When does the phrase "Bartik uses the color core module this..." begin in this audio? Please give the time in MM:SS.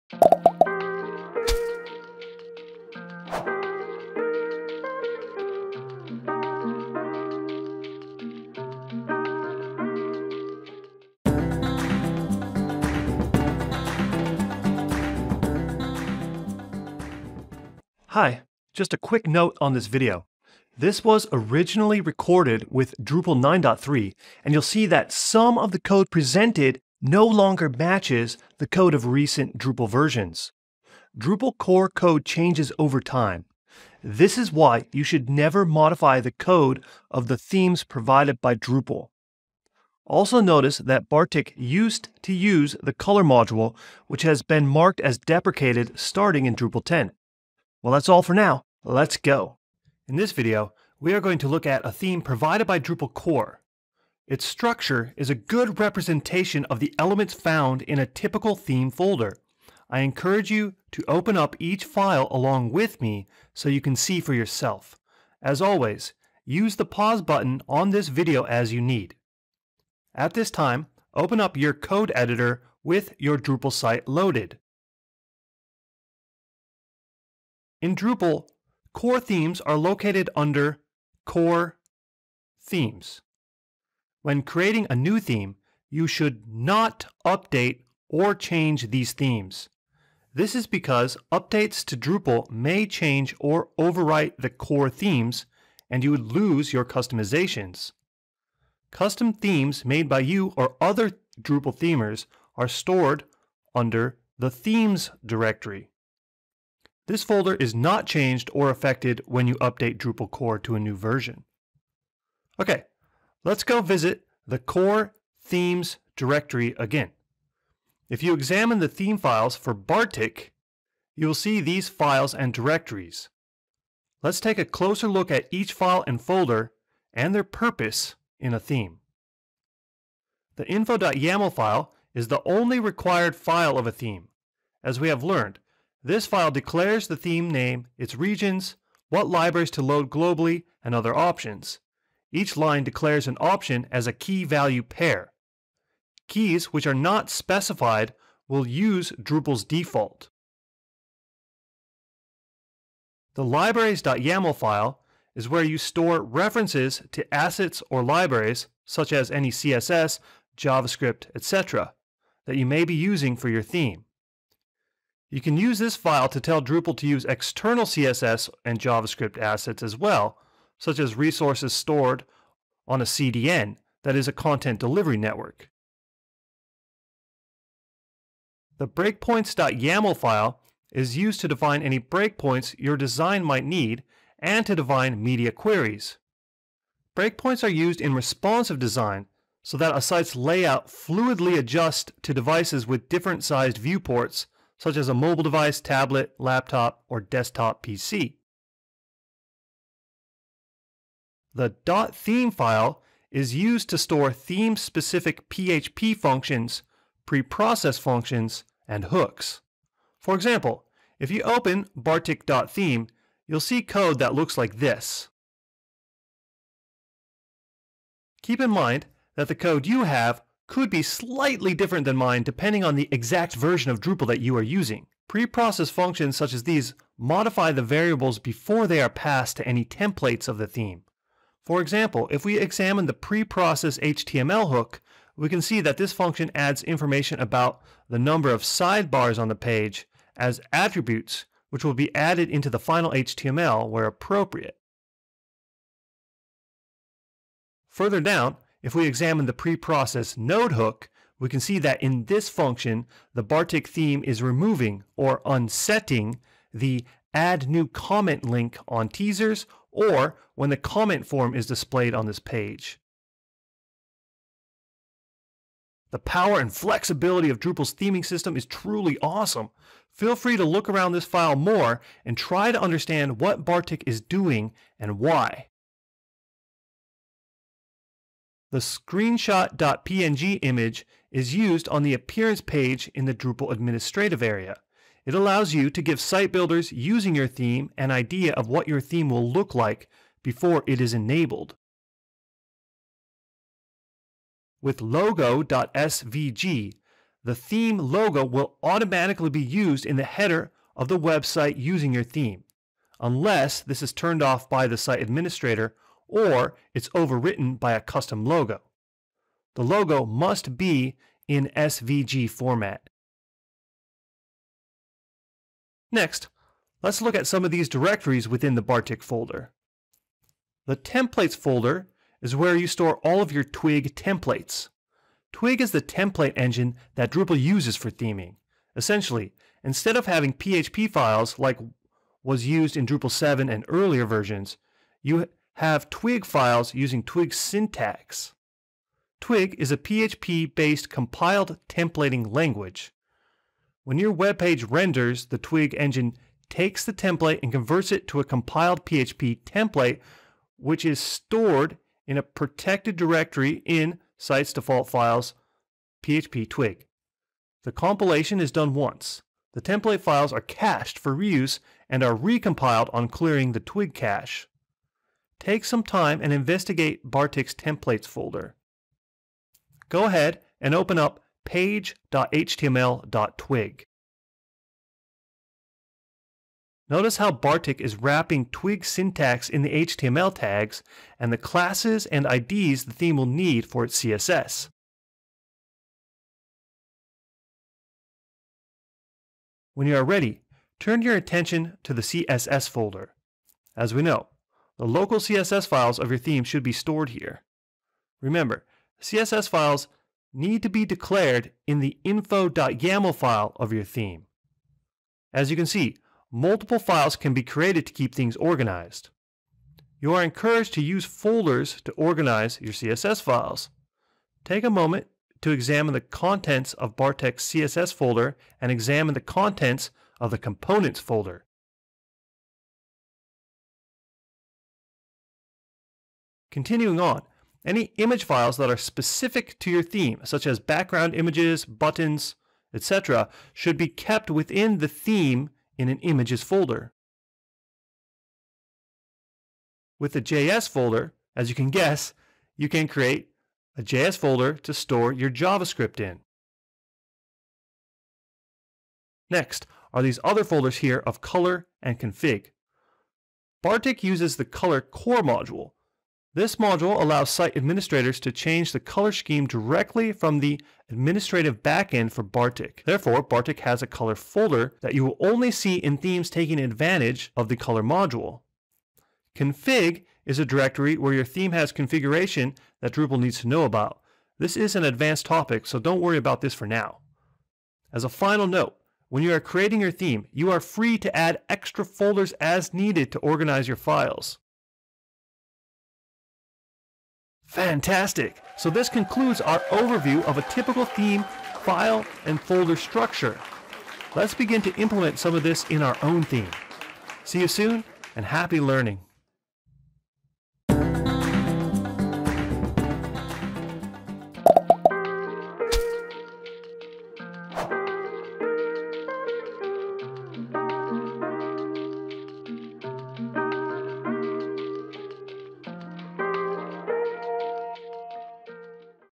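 07:33.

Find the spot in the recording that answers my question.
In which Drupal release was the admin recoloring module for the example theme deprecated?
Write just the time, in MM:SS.
00:46.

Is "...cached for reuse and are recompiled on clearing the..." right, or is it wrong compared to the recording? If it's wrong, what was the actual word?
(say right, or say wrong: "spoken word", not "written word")
right.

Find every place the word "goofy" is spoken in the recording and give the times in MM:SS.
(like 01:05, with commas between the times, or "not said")
not said.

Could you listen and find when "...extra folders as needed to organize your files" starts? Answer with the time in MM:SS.
08:01.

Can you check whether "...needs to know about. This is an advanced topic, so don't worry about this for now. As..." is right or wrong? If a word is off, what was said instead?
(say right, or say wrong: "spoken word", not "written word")
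right.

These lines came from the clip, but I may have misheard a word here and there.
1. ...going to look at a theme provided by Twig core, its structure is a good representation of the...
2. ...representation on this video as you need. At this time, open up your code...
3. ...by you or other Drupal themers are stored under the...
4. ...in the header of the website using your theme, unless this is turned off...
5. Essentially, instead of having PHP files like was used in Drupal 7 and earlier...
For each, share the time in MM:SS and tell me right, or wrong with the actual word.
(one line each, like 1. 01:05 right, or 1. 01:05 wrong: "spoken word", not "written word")
1. 00:51 wrong: "Drupal", not "Twig"
2. 01:07 wrong: "button", not "representation"
3. 01:40 right
4. 05:00 right
5. 05:28 right.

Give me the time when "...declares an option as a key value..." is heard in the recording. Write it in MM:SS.
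02:22.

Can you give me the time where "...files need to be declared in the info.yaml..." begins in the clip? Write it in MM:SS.
06:39.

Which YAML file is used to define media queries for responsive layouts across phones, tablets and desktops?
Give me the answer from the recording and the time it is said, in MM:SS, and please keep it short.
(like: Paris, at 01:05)
breakpoints.yaml, at 02:58.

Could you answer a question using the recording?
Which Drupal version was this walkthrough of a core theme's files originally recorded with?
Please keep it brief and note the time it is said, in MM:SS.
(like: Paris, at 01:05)
Drupal 9.3, at 00:23.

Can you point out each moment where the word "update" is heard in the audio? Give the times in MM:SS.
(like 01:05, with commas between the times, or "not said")
01:27, 01:31, 01:49.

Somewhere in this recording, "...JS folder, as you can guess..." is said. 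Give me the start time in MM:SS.
07:20.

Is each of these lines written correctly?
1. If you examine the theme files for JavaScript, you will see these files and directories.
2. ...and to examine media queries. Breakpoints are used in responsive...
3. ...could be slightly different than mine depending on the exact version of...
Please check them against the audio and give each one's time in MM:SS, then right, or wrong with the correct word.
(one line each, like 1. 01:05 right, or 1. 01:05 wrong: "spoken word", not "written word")
1. 01:58 wrong: "Bartik", not "JavaScript"
2. 03:04 wrong: "define", not "examine"
3. 03:40 right.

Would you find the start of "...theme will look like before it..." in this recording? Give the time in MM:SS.
04:49.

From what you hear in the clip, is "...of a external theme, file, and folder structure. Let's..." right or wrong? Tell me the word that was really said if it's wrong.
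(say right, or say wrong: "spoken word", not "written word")
wrong: "typical", not "external".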